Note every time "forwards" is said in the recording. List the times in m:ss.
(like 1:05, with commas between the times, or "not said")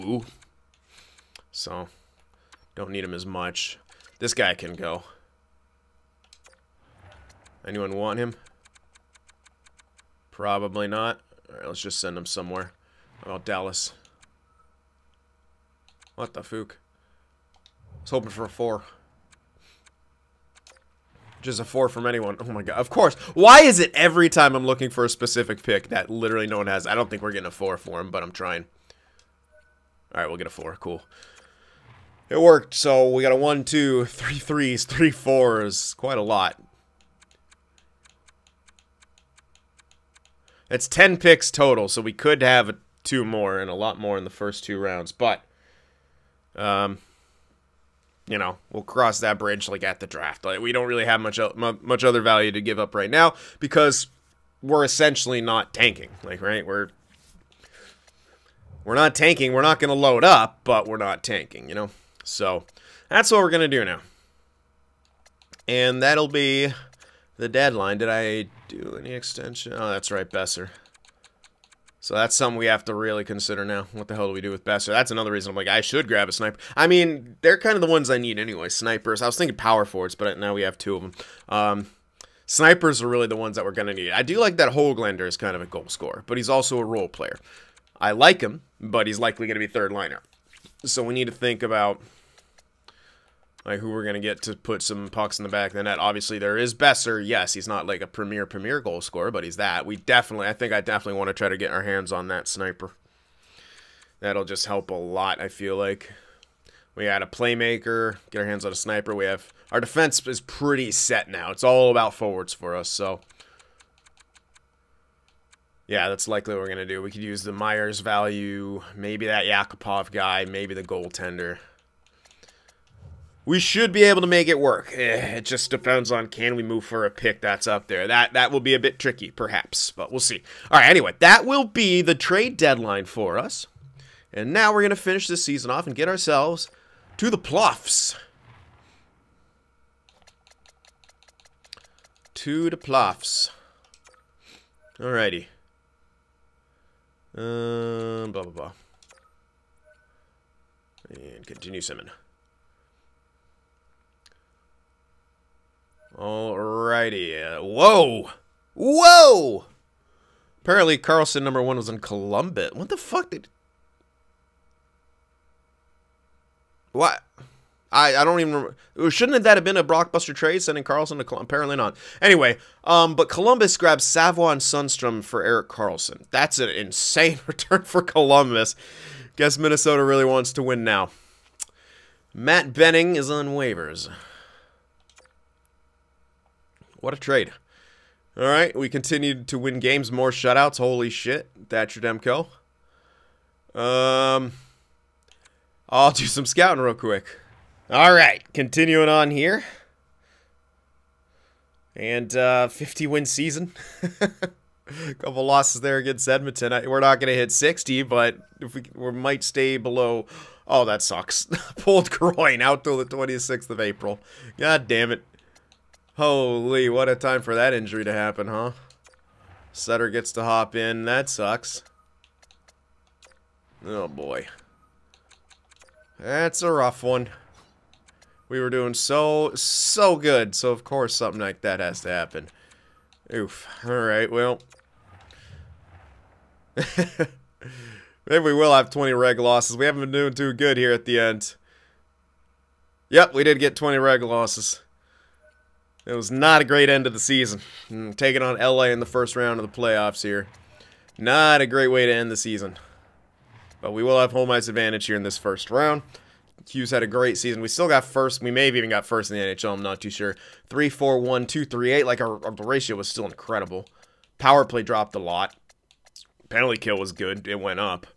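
1:19, 1:52.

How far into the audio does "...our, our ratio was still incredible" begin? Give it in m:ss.
4:22.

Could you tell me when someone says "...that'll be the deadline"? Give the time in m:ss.
1:06.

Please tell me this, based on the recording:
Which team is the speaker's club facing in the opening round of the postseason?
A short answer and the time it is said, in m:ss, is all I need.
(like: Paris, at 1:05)
LA, at 4:08.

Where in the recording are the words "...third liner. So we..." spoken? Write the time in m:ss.
1:29.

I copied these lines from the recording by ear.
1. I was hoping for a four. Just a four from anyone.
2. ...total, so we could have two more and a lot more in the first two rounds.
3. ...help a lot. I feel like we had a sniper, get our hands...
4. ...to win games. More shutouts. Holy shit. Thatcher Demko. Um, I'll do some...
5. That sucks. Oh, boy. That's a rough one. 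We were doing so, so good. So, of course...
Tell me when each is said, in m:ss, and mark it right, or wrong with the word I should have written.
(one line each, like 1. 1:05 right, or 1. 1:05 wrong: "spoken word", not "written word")
1. 0:16 right
2. 0:41 right
3. 1:44 wrong: "playmaker", not "sniper"
4. 3:09 right
5. 3:41 right.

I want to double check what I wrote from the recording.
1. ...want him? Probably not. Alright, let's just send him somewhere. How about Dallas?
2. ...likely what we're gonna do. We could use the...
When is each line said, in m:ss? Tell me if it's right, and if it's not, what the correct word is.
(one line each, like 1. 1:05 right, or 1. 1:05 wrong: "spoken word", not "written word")
1. 0:07 right
2. 1:56 right.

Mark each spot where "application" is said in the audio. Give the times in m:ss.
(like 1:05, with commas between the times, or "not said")
not said.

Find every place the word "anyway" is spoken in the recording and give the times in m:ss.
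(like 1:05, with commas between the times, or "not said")
1:18, 2:10, 2:52.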